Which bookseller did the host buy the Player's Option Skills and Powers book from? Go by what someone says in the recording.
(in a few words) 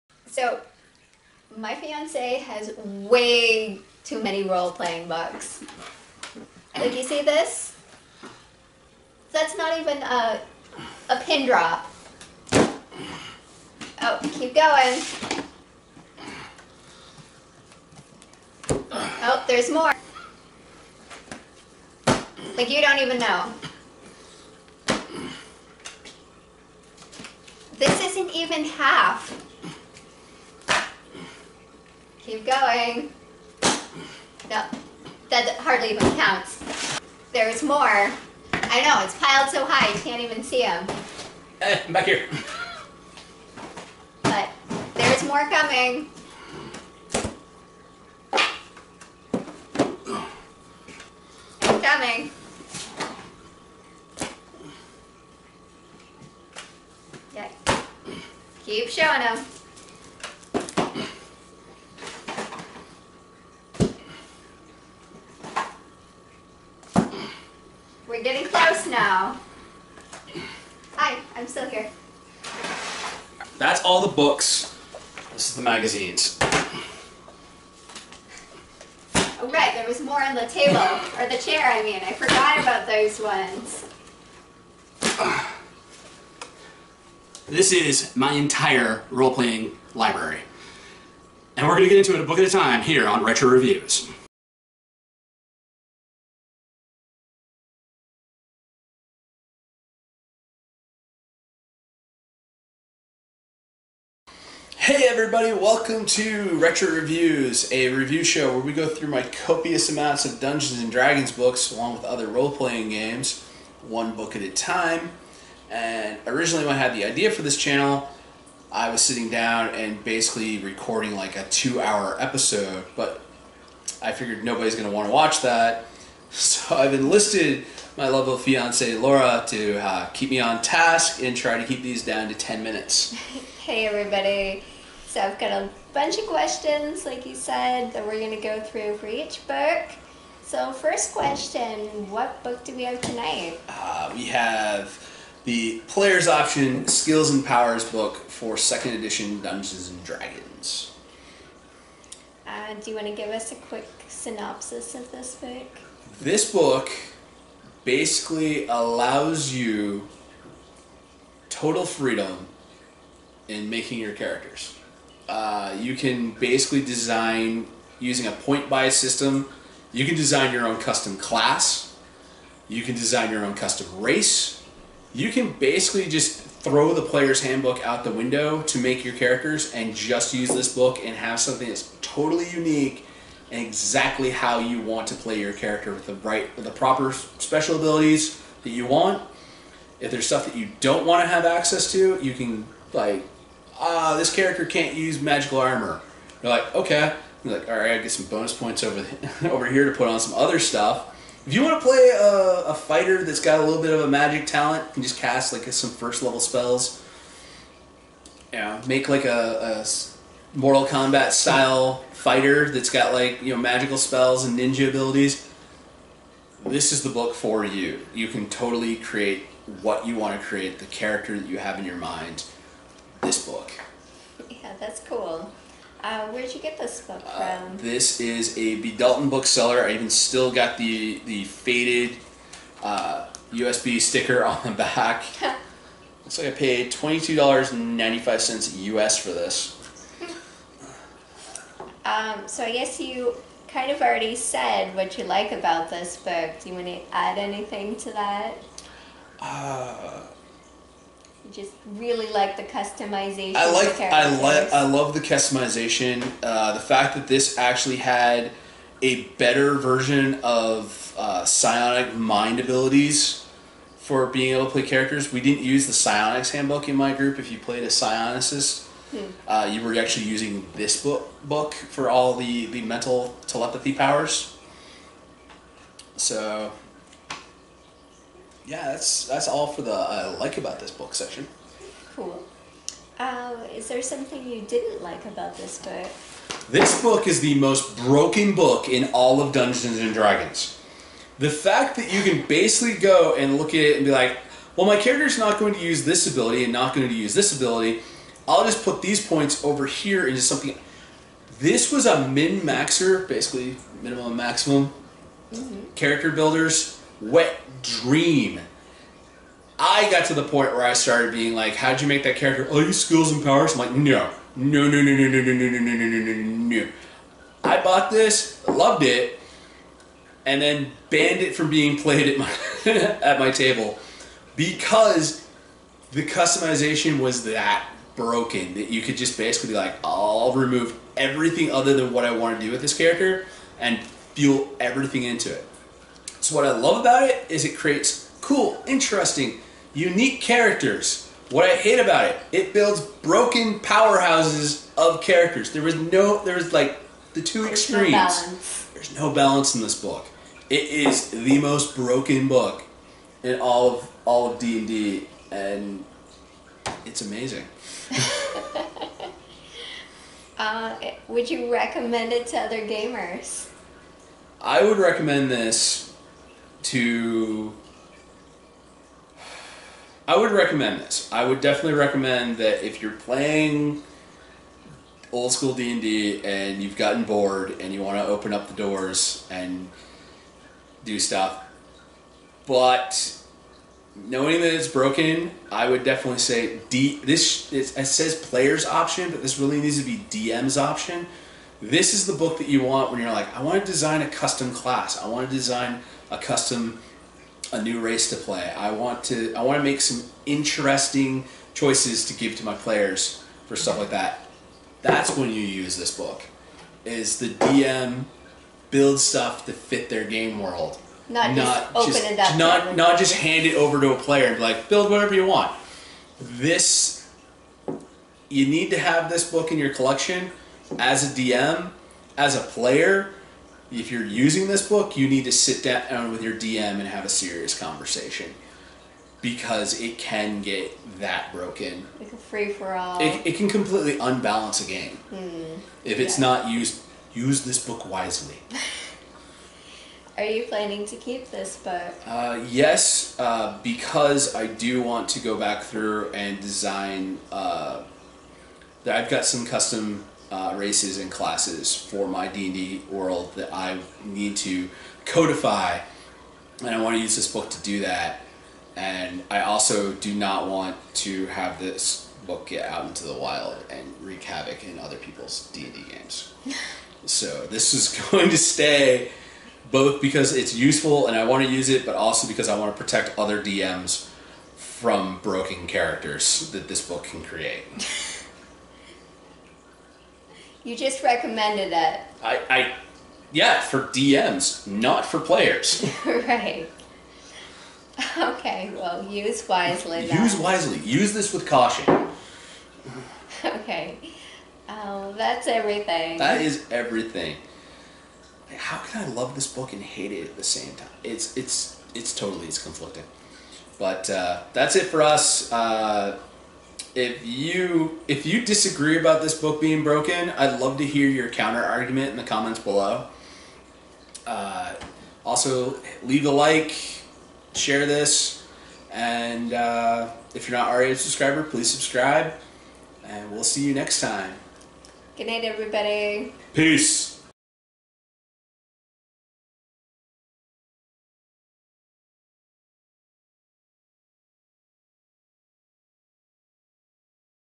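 B. Dalton.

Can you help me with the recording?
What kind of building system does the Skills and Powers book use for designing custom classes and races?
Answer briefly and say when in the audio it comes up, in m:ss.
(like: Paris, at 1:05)
Point buy, at 2:48.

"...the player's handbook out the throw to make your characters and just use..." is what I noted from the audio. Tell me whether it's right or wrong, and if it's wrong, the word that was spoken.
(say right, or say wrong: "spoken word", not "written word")
wrong: "window", not "throw".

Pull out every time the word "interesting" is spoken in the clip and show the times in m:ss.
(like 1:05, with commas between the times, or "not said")
5:38, 6:40.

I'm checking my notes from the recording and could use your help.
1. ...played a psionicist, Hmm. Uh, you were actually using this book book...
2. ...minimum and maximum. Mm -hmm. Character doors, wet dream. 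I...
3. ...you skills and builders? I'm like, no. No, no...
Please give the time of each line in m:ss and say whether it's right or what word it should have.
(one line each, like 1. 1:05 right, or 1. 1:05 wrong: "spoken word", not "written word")
1. 4:27 right
2. 5:04 wrong: "builders", not "doors"
3. 5:12 wrong: "powers", not "builders".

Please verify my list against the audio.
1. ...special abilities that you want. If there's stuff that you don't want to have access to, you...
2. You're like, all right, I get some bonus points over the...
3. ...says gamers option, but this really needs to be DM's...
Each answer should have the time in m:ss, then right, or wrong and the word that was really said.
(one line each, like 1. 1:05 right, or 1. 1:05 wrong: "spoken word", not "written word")
1. 3:07 right
2. 3:17 right
3. 6:28 wrong: "players", not "gamers".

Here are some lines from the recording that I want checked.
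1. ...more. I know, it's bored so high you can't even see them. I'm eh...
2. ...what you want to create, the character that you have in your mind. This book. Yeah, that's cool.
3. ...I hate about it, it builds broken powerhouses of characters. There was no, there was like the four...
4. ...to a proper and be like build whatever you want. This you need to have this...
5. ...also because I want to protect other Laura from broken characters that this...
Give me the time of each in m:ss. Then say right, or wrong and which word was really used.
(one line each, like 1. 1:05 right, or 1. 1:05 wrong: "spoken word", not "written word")
1. 0:37 wrong: "piled", not "bored"
2. 3:39 right
3. 5:41 wrong: "two", not "four"
4. 6:54 wrong: "player", not "proper"
5. 7:52 wrong: "DMs", not "Laura".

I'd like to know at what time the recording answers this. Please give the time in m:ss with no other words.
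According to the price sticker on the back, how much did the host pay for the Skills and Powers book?
3:56.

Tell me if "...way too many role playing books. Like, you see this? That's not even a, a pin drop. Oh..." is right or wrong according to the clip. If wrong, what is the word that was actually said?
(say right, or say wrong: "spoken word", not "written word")
right.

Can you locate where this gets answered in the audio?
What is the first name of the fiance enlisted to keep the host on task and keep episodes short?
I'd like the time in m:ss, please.
2:08.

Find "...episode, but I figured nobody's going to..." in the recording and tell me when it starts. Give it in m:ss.
2:02.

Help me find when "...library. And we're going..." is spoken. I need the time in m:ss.
1:29.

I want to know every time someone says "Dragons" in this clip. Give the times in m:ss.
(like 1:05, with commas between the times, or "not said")
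1:50, 2:30, 4:50.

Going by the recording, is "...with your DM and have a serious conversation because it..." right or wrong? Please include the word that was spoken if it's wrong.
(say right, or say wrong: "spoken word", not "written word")
right.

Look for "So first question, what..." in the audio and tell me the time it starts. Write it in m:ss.
2:20.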